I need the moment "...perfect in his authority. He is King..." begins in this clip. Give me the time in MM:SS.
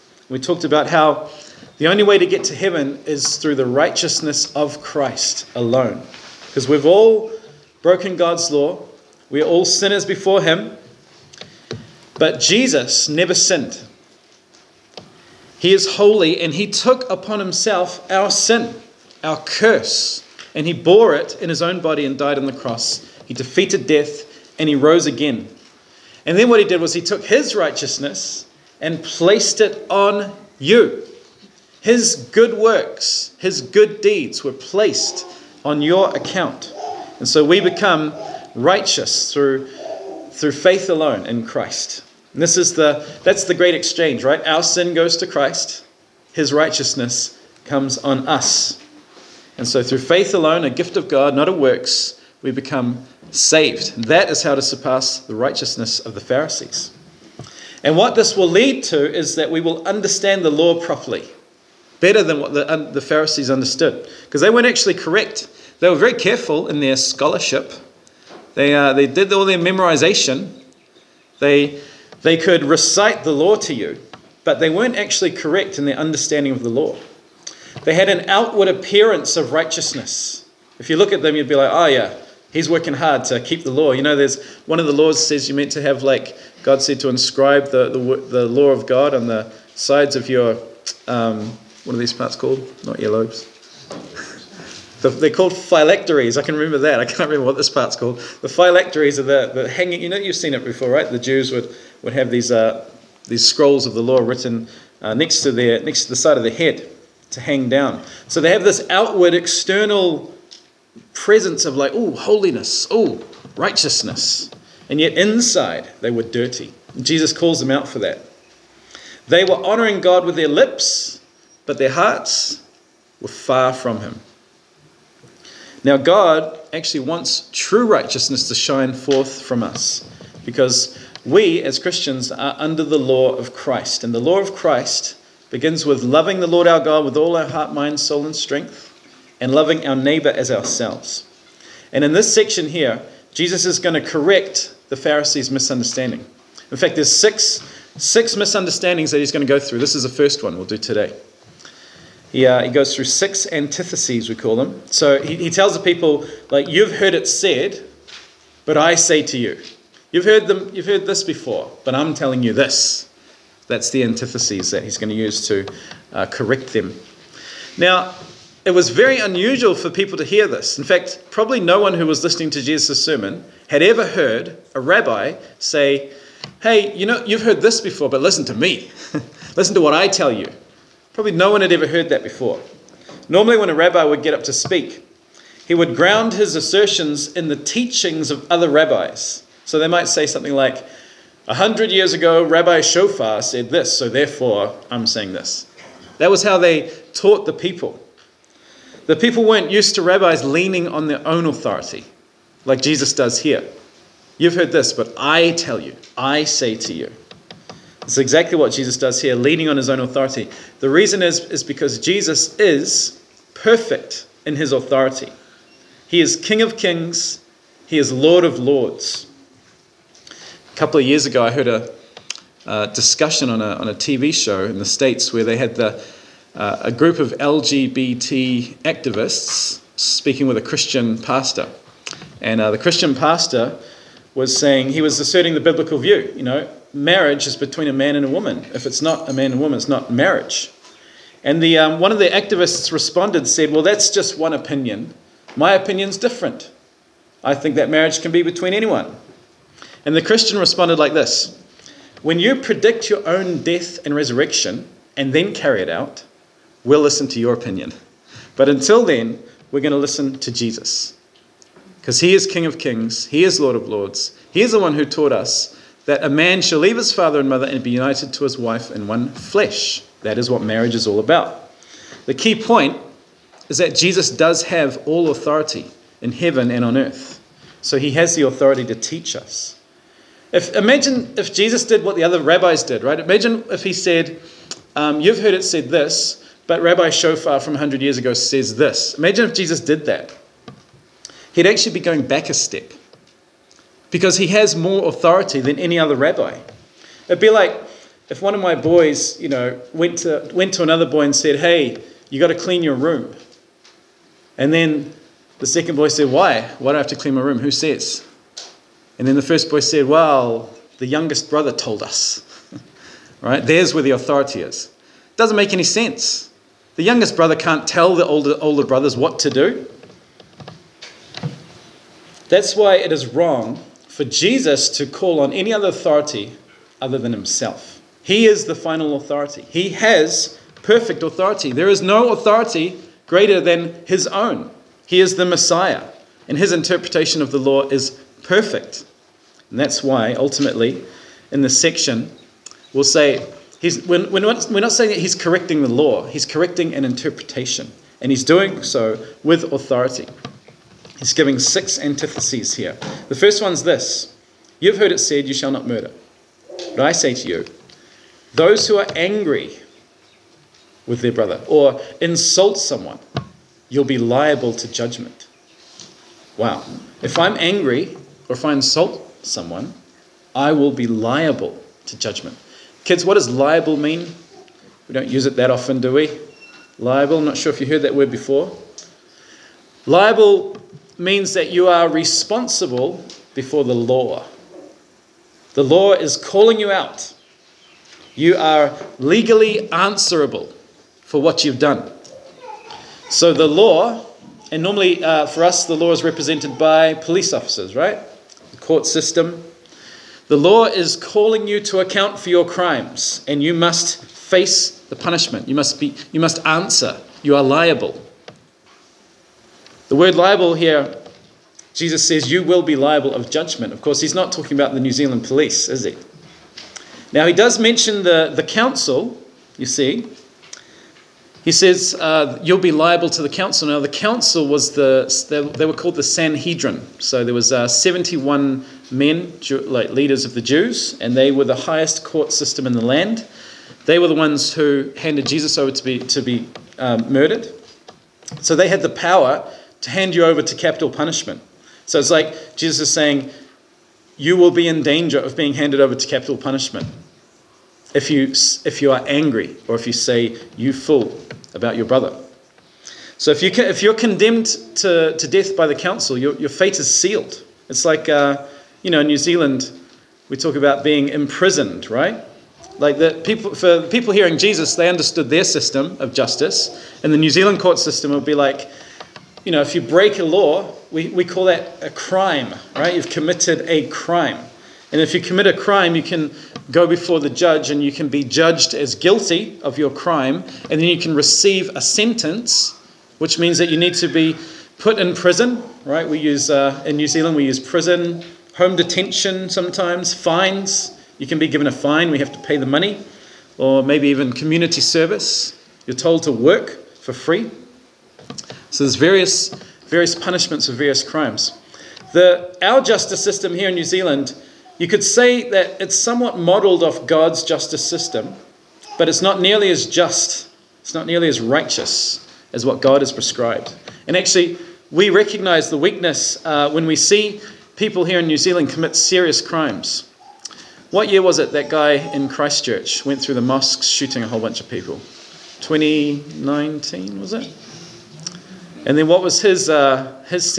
03:33.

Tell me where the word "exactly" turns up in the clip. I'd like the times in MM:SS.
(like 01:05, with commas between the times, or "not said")
03:28.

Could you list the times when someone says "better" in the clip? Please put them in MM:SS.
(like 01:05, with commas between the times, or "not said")
01:02.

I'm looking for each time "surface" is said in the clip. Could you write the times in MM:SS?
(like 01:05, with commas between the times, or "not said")
not said.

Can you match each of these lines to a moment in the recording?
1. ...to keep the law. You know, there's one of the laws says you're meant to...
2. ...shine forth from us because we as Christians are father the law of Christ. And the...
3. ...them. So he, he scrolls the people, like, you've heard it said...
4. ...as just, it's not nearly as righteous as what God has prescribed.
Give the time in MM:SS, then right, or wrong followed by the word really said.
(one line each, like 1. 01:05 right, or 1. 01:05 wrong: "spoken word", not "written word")
1. 01:23 right
2. 02:08 wrong: "under", not "father"
3. 02:34 wrong: "tells", not "scrolls"
4. 08:29 right.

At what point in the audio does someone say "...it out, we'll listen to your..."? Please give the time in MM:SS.
04:15.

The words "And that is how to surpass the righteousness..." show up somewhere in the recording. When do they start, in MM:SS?
00:53.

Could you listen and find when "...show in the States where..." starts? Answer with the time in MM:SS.
03:44.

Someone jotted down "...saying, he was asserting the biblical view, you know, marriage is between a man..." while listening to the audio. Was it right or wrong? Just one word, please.
right.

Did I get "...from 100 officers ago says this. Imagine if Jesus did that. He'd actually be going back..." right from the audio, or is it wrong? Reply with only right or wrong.
wrong.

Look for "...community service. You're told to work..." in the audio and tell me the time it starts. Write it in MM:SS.
08:14.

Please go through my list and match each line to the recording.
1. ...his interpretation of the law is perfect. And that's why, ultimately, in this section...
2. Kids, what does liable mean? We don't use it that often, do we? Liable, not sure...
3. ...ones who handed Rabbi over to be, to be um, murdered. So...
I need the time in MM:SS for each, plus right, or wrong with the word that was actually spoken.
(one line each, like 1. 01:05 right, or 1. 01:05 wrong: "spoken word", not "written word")
1. 05:36 right
2. 06:13 right
3. 07:14 wrong: "Jesus", not "Rabbi".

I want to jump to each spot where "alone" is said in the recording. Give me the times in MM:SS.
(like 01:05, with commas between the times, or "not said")
00:05, 00:40, 00:50.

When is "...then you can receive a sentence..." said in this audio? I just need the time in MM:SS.
08:01.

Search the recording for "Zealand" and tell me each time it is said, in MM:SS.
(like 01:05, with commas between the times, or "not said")
06:55, 07:39, 07:47, 08:07, 08:24, 08:38.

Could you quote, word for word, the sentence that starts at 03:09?
So they might say something like, A hundred years ago, Rabbi Shofar said this, so therefore I'm saying this.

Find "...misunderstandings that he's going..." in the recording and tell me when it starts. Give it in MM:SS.
02:28.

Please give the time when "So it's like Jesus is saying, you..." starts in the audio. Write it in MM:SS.
07:22.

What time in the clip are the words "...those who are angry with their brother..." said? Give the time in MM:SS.
05:58.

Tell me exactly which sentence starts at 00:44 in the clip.
Our sin goes to Christ, his righteousness comes on us.